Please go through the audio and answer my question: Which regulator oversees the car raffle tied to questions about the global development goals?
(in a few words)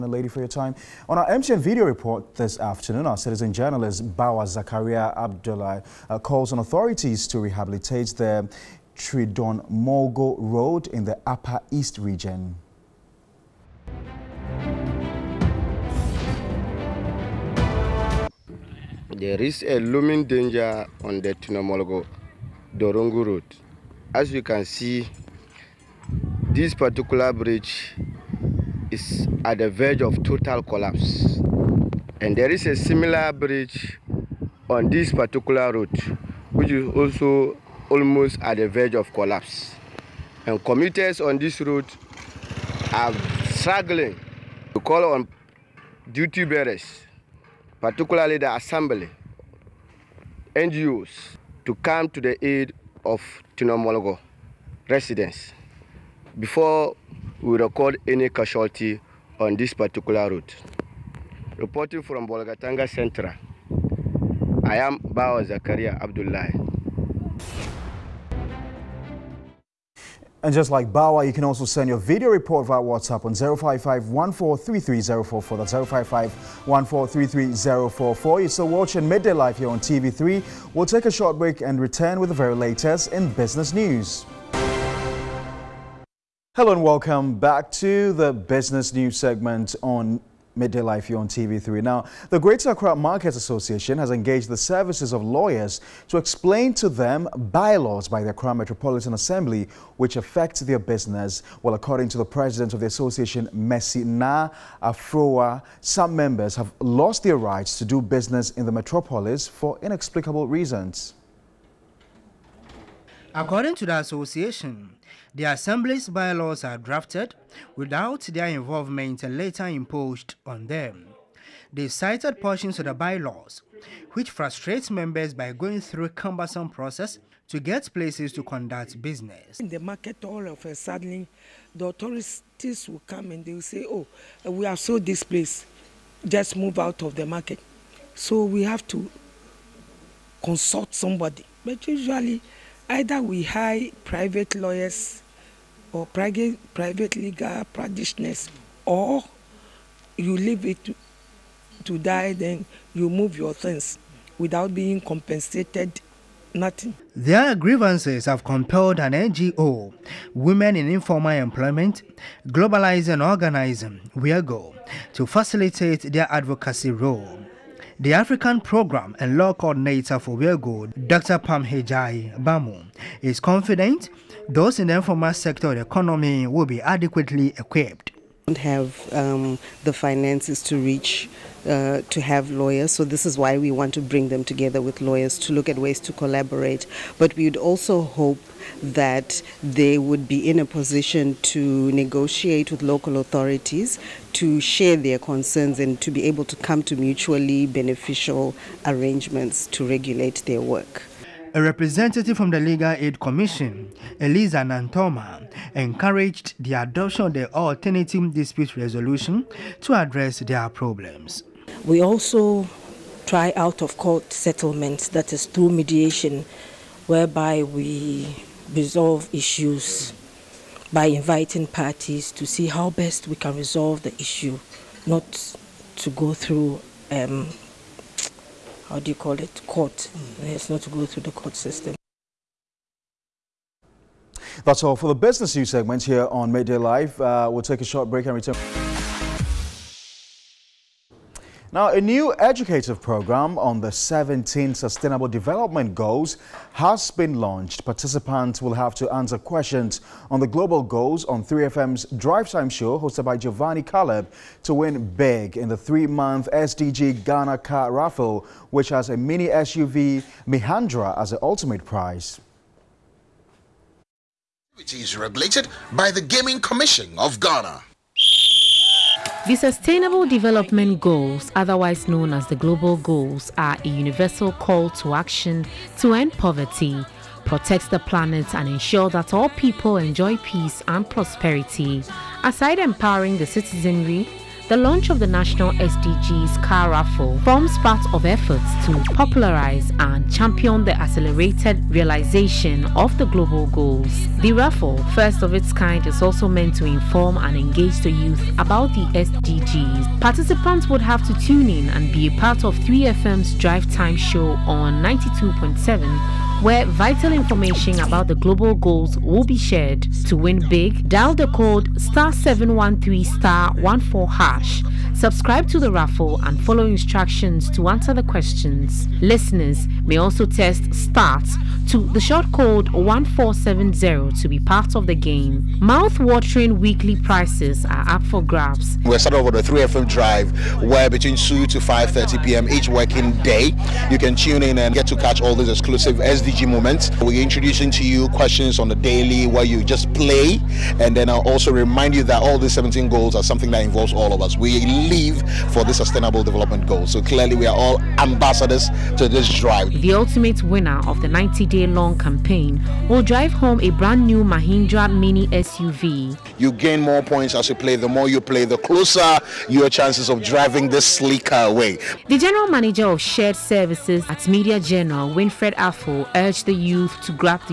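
Gaming Commission of Ghana.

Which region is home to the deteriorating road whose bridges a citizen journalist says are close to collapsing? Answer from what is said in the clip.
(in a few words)
Upper East.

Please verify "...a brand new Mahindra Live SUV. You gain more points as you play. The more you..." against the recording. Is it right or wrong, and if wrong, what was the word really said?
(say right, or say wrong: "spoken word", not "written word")
wrong: "Mini", not "Live".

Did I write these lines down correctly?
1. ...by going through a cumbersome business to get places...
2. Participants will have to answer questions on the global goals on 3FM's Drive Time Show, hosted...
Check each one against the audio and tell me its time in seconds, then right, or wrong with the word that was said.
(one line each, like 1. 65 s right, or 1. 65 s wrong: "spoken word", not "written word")
1. 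125 s wrong: "process", not "business"
2. 247 s right.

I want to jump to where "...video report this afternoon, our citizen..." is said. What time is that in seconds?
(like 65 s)
1 s.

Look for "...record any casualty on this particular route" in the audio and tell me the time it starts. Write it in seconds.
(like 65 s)
57 s.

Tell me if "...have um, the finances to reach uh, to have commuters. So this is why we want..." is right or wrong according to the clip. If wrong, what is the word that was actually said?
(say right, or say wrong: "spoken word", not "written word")
wrong: "lawyers", not "commuters".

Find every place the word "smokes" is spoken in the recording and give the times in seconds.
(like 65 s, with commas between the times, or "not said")
not said.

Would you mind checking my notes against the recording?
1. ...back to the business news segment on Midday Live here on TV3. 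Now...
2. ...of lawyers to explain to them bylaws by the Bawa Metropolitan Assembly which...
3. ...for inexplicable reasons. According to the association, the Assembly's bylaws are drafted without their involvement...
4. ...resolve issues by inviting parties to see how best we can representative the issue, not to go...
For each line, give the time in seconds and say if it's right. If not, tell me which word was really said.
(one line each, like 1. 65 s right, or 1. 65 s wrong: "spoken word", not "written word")
1. 87 s right
2. 95 s wrong: "Accra", not "Bawa"
3. 109 s right
4. 218 s wrong: "resolve", not "representative".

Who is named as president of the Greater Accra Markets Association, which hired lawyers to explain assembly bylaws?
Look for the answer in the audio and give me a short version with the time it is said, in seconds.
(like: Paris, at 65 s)
Messina Afroa, at 103 s.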